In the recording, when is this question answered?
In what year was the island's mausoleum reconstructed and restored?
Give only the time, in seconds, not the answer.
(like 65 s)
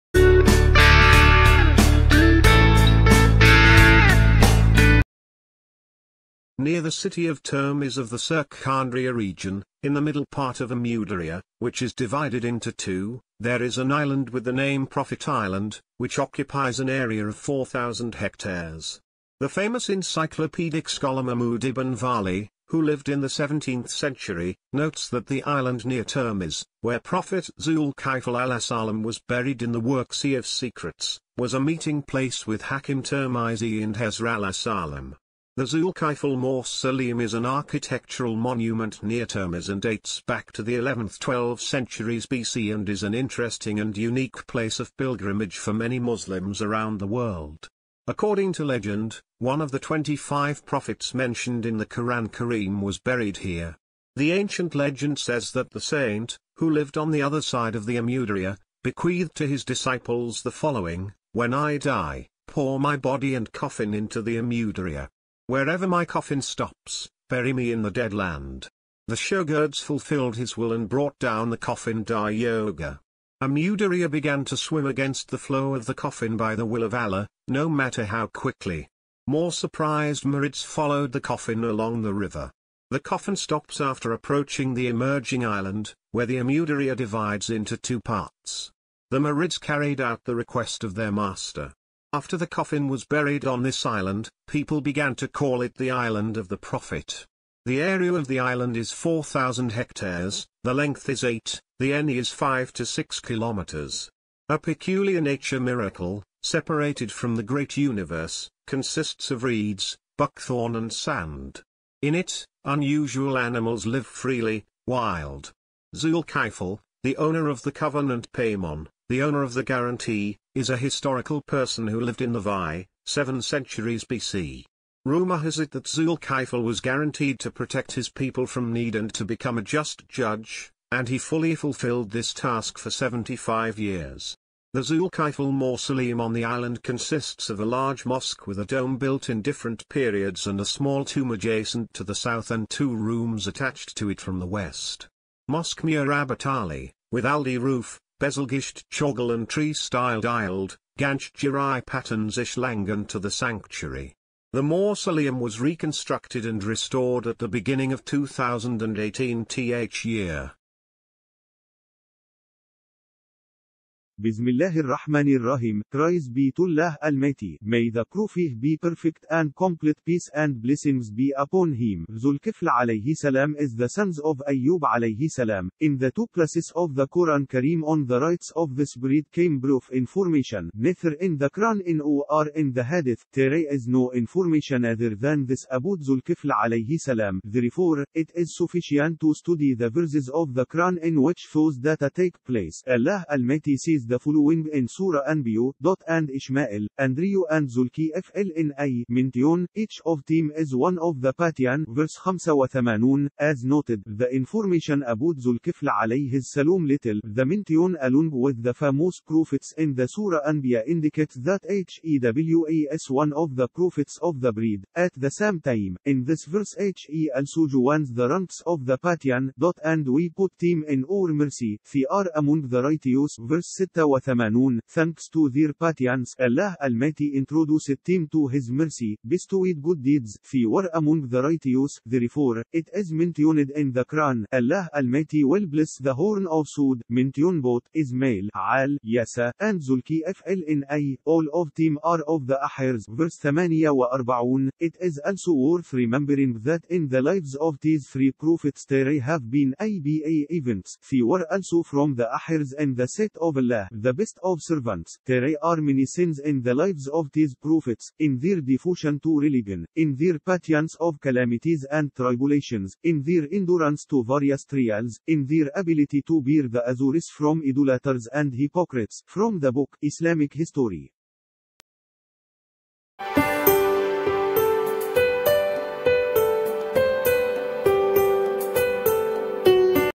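158 s.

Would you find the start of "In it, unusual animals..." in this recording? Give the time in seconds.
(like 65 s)
112 s.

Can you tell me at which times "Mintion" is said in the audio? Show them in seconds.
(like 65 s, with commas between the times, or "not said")
199 s, 207 s.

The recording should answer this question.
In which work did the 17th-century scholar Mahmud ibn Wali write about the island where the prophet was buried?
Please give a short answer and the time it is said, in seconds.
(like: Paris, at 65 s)
Sea of Secrets, at 30 s.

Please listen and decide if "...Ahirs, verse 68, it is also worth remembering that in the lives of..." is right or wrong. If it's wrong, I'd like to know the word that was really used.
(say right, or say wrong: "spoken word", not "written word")
wrong: "48", not "68".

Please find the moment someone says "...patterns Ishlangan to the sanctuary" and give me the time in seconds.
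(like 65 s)
151 s.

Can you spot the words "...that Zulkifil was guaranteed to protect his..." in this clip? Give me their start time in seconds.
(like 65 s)
125 s.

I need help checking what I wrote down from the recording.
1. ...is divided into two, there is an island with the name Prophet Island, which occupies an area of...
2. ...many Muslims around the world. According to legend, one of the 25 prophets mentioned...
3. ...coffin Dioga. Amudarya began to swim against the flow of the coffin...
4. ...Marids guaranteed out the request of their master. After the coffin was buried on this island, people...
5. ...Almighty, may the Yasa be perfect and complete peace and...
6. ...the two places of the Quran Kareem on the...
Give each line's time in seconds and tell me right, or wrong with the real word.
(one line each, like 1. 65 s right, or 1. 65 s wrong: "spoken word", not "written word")
1. 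11 s right
2. 45 s right
3. 71 s right
4. 89 s wrong: "carried", not "guaranteed"
5. 167 s wrong: "Prophet", not "Yasa"
6. 175 s right.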